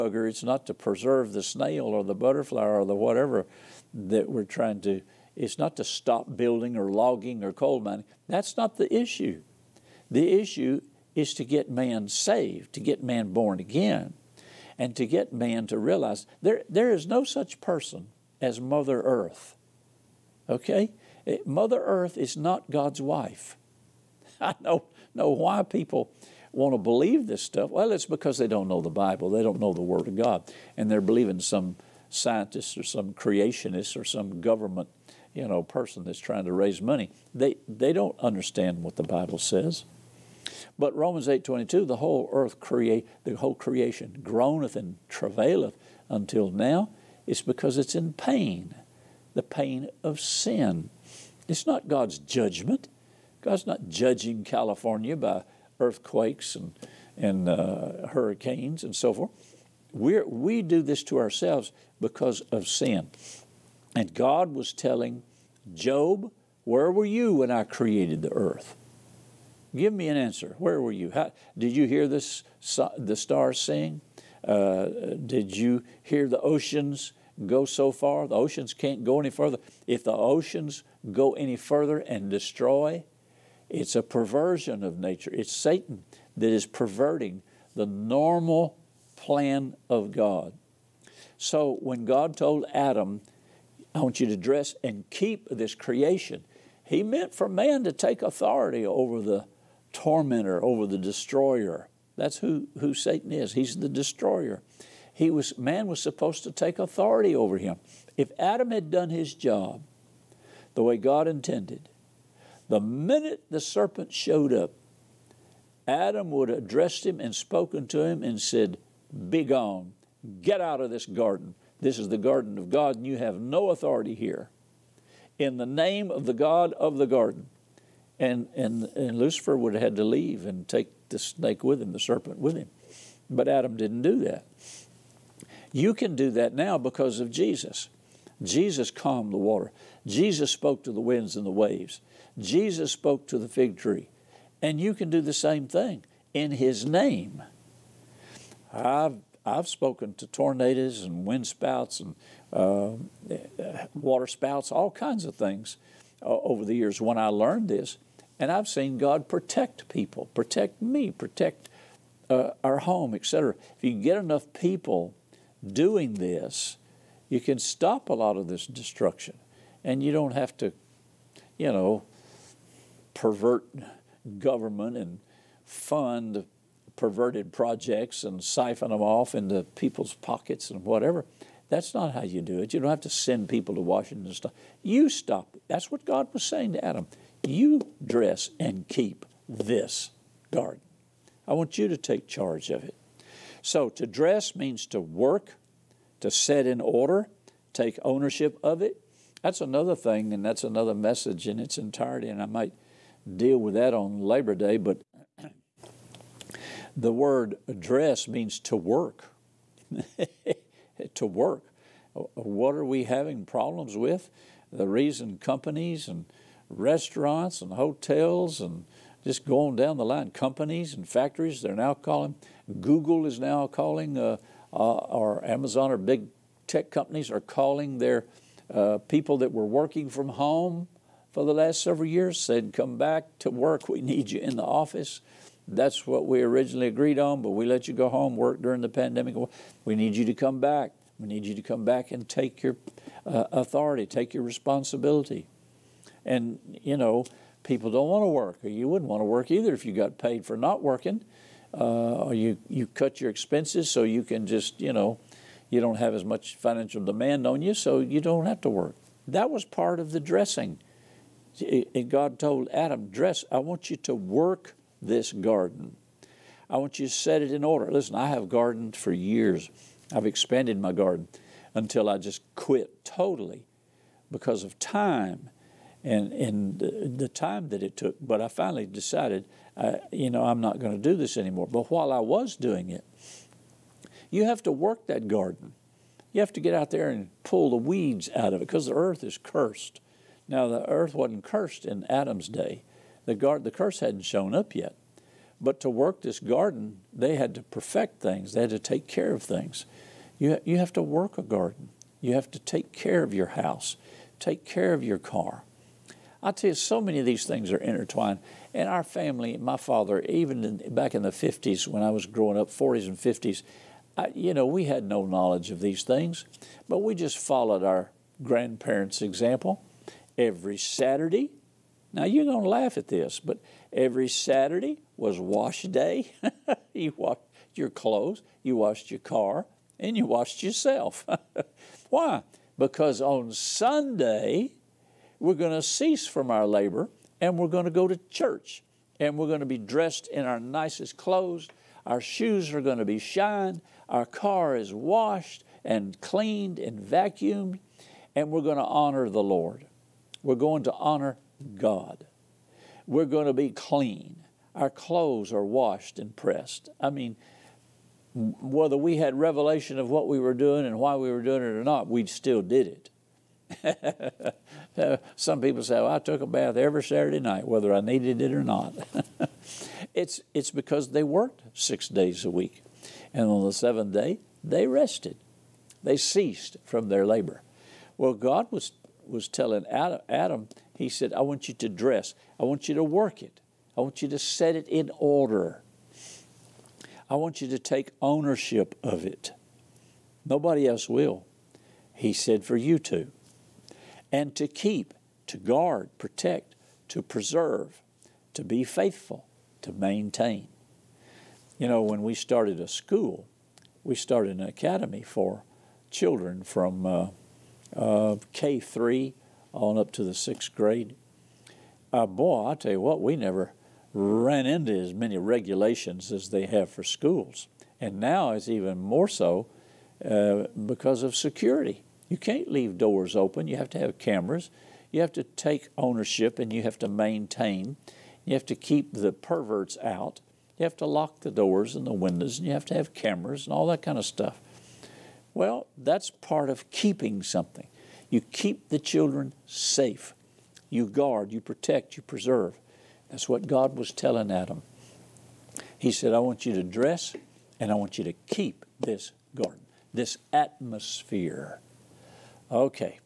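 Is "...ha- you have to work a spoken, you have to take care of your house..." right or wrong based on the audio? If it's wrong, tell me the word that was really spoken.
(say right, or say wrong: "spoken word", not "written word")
wrong: "garden", not "spoken".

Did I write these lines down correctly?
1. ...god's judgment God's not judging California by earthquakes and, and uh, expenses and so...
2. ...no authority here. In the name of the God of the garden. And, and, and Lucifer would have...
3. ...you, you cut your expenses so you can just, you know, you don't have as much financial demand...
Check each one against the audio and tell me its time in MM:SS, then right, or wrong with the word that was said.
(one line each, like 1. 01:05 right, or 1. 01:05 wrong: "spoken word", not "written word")
1. 00:51 wrong: "hurricanes", not "expenses"
2. 02:03 right
3. 04:12 right.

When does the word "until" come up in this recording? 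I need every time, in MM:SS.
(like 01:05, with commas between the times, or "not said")
00:46, 04:31.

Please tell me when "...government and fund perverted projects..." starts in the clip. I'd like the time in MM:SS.
02:54.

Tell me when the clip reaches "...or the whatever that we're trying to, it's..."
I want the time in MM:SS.
00:02.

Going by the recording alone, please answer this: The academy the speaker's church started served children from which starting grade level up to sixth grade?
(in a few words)
K3.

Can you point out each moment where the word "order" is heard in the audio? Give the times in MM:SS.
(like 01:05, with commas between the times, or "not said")
03:16, 04:27, 06:25.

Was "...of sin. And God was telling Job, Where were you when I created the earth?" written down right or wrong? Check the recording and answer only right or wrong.
right.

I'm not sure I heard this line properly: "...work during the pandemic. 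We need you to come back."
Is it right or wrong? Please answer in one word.
right.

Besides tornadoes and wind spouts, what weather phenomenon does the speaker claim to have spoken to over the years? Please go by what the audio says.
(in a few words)
water spouts.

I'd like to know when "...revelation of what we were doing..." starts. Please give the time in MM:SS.
05:59.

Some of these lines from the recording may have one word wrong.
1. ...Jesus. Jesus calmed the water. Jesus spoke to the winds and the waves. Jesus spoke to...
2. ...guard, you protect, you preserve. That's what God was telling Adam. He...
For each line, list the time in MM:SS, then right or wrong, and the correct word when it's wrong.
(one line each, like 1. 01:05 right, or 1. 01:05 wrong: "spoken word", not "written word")
1. 02:17 right
2. 07:21 right.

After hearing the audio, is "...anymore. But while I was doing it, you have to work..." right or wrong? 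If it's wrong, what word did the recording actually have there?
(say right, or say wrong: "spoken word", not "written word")
right.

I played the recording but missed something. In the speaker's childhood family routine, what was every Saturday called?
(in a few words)
wash day.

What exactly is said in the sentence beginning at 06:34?
And to keep, to guard, protect, to preserve, to be faithful, to maintain.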